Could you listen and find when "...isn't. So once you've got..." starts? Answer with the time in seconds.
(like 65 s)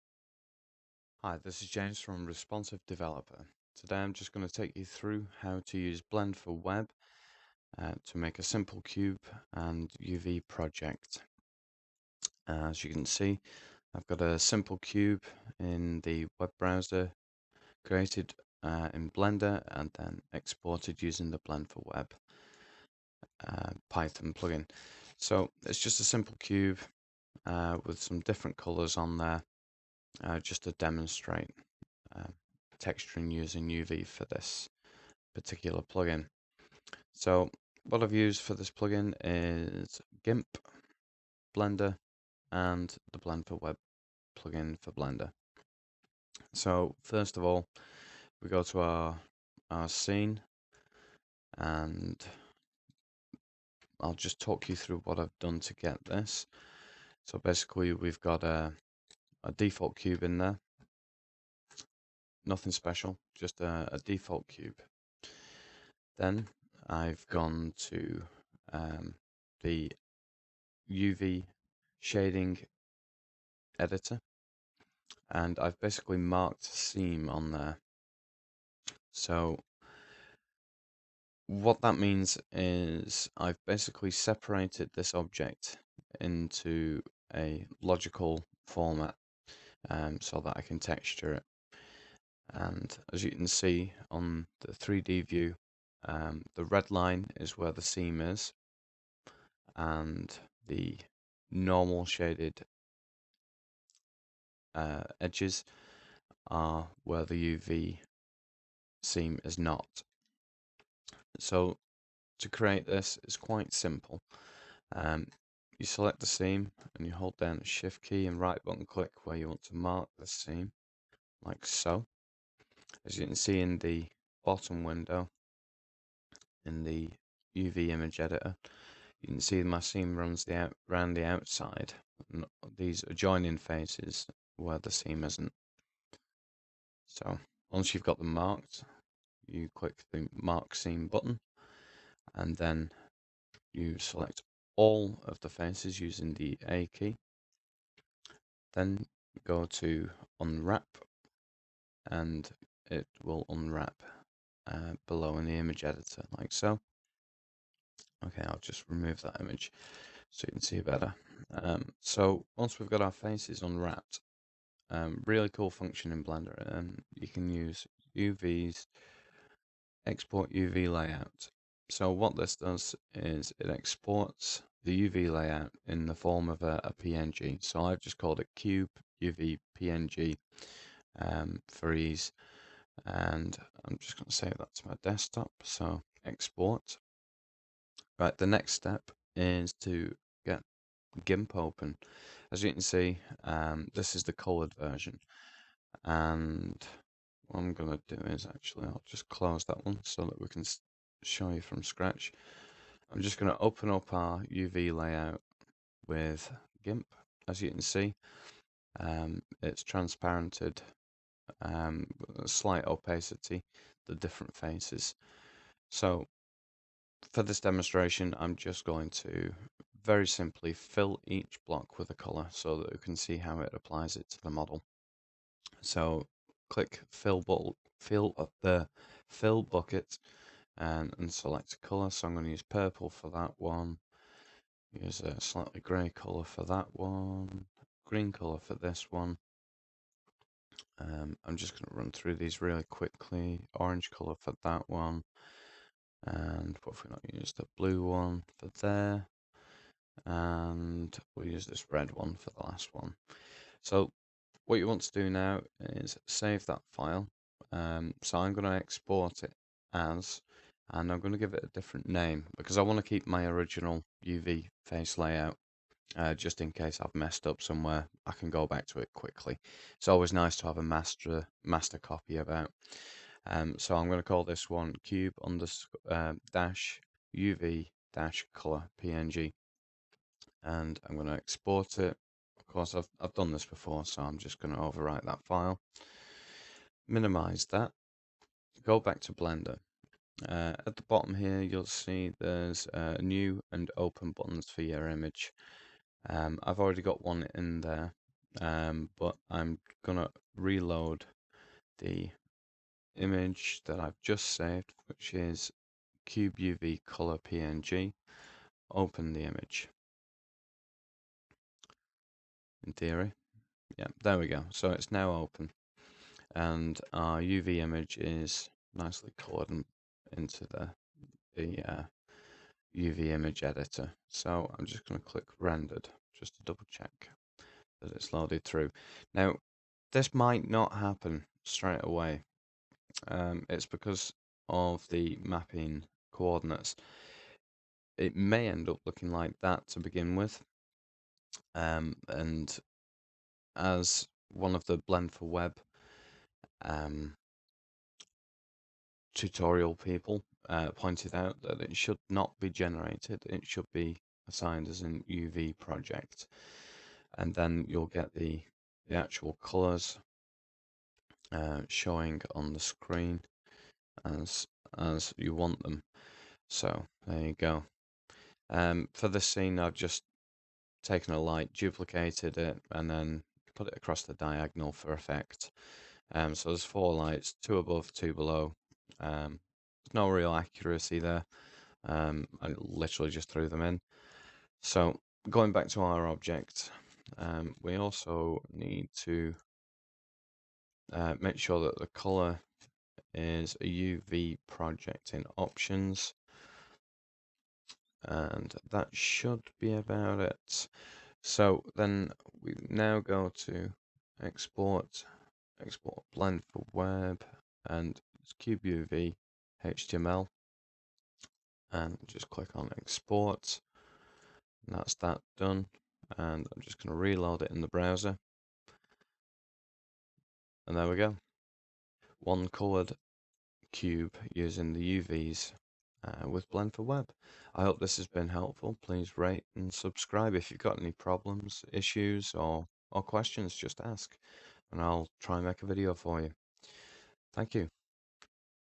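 135 s.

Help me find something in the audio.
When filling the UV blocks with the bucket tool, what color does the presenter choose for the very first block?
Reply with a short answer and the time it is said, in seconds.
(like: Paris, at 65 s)
Purple, at 232 s.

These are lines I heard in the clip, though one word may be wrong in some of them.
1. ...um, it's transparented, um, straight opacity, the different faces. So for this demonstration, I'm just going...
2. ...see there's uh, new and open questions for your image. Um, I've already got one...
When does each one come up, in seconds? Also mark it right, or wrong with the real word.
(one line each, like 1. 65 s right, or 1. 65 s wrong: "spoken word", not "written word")
1. 208 s wrong: "slight", not "straight"
2. 291 s wrong: "buttons", not "questions".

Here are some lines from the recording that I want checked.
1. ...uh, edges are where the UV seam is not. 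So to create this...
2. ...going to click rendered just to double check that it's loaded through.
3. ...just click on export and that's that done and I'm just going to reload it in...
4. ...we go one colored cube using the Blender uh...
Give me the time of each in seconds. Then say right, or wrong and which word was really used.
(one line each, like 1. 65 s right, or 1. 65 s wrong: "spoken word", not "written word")
1. 104 s right
2. 325 s right
3. 412 s right
4. 421 s wrong: "UVs", not "Blender".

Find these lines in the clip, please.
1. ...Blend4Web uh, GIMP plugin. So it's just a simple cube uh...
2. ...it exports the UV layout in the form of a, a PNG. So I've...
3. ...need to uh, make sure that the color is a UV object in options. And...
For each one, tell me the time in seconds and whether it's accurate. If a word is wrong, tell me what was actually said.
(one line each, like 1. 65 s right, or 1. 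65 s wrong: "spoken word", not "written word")
1. 21 s wrong: "Python", not "GIMP"
2. 173 s right
3. 388 s wrong: "project", not "object".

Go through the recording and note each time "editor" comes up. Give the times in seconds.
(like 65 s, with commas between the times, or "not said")
73 s, 128 s, 155 s, 323 s.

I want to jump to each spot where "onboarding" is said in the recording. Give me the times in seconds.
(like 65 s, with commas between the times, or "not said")
not said.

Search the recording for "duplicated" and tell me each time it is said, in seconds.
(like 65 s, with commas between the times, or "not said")
371 s.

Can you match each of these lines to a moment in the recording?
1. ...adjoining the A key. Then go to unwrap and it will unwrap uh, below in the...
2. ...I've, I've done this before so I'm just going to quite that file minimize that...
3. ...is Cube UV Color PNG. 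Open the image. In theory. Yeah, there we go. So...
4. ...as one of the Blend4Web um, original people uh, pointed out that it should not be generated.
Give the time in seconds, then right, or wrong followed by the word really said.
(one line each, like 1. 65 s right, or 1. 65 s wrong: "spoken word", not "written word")
1. 145 s wrong: "using", not "adjoining"
2. 282 s wrong: "overwrite", not "quite"
3. 305 s right
4. 343 s wrong: "tutorial", not "original".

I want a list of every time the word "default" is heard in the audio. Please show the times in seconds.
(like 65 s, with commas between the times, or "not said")
59 s, 63 s.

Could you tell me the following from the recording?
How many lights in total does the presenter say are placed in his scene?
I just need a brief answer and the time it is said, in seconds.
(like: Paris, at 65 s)
4, at 376 s.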